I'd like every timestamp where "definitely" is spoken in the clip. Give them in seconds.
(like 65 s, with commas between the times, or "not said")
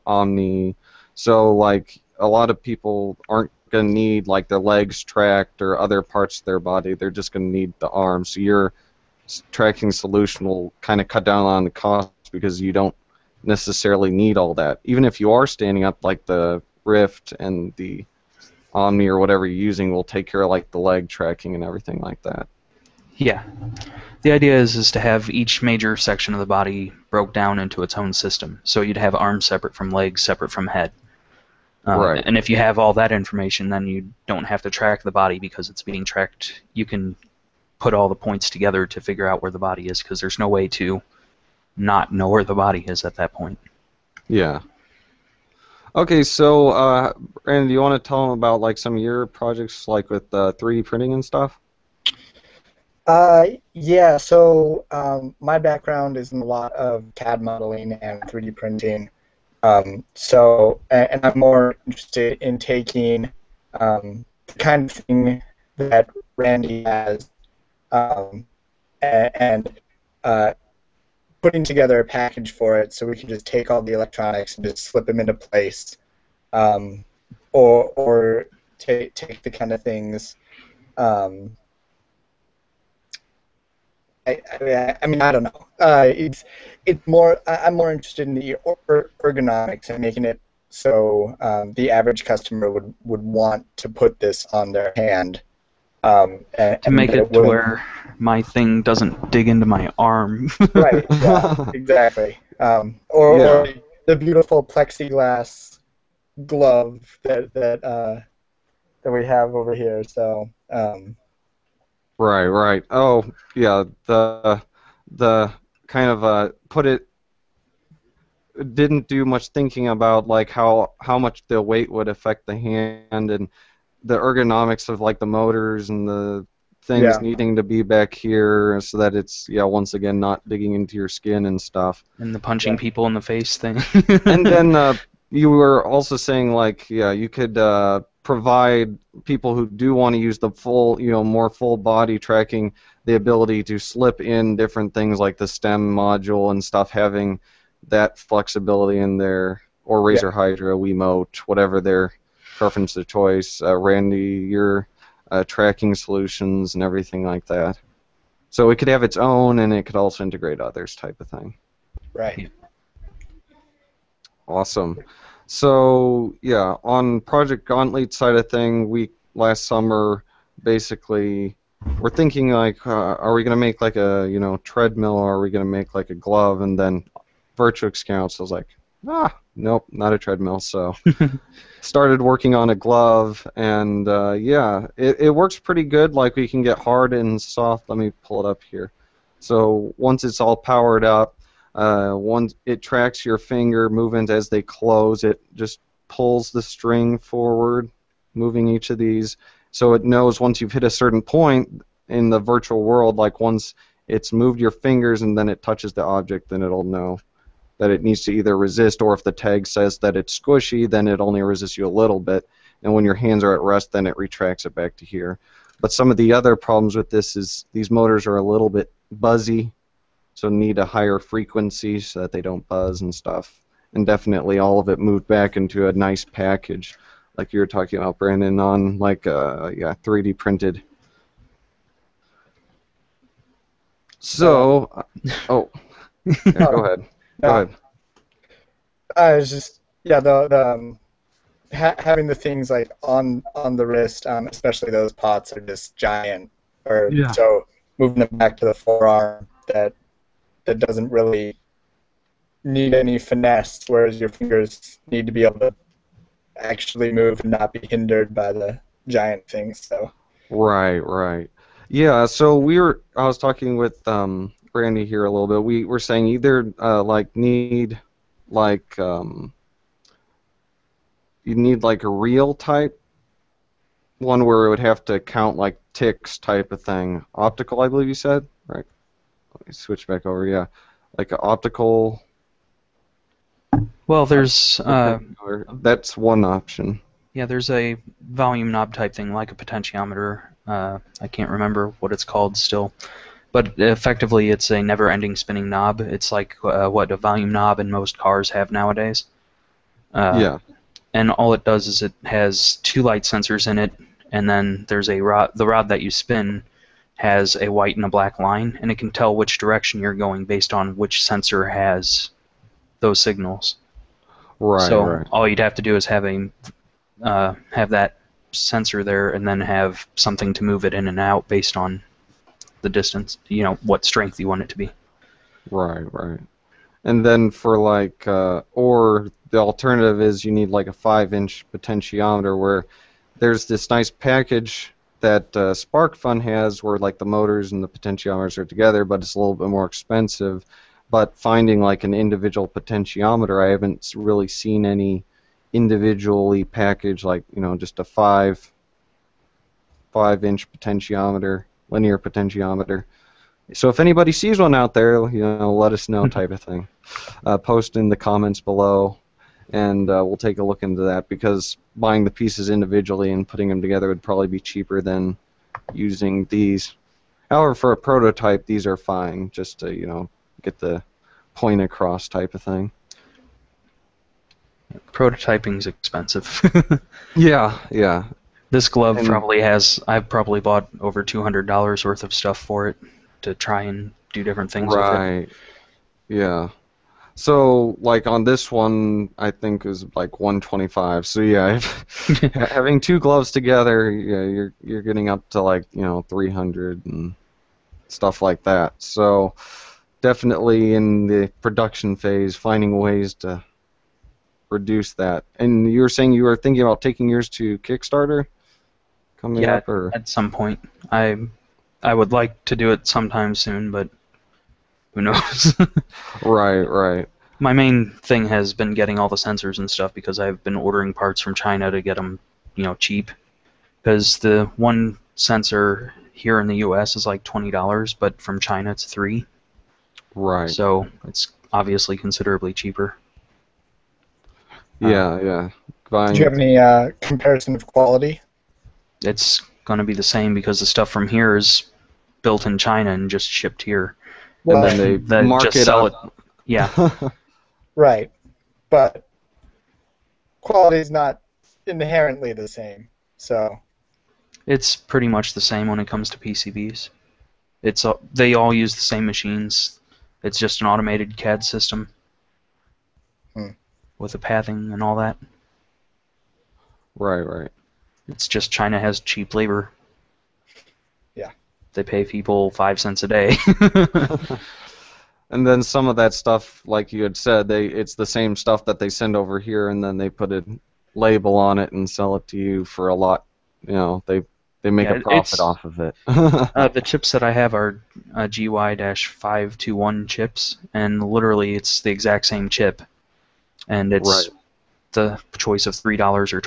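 224 s, 400 s.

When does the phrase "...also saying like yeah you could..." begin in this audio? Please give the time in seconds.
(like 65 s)
135 s.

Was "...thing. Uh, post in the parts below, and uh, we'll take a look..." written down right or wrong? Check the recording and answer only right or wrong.
wrong.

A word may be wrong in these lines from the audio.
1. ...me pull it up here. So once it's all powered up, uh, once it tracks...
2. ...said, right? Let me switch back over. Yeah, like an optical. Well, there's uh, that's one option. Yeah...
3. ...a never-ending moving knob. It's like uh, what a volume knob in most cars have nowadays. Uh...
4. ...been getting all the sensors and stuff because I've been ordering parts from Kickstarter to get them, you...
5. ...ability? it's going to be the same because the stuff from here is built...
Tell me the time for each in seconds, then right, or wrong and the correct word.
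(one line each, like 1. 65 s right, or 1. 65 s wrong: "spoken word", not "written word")
1. 187 s right
2. 278 s right
3. 294 s wrong: "spinning", not "moving"
4. 418 s wrong: "China", not "Kickstarter"
5. 437 s wrong: "quality", not "ability".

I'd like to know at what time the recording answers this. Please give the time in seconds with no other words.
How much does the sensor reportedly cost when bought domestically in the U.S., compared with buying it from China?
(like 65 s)
427 s.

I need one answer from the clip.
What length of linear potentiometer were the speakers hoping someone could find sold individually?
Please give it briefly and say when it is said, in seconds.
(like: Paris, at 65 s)
5 inches, at 330 s.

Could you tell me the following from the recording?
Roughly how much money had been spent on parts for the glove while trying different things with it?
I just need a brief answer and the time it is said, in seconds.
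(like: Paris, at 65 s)
over $200, at 380 s.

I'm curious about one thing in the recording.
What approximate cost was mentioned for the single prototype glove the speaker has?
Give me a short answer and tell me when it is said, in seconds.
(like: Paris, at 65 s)
125, at 390 s.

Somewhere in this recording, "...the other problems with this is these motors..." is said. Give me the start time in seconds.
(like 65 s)
216 s.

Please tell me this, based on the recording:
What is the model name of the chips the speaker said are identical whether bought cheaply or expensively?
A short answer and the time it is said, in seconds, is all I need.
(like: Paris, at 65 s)
GY-521, at 488 s.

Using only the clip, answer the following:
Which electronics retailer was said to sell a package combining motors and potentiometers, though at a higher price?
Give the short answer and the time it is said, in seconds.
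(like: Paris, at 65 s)
SparkFun, at 335 s.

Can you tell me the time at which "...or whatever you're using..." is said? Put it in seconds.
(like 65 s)
19 s.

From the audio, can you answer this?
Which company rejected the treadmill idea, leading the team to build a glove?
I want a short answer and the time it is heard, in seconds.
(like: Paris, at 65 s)
Virtual Scouts, at 177 s.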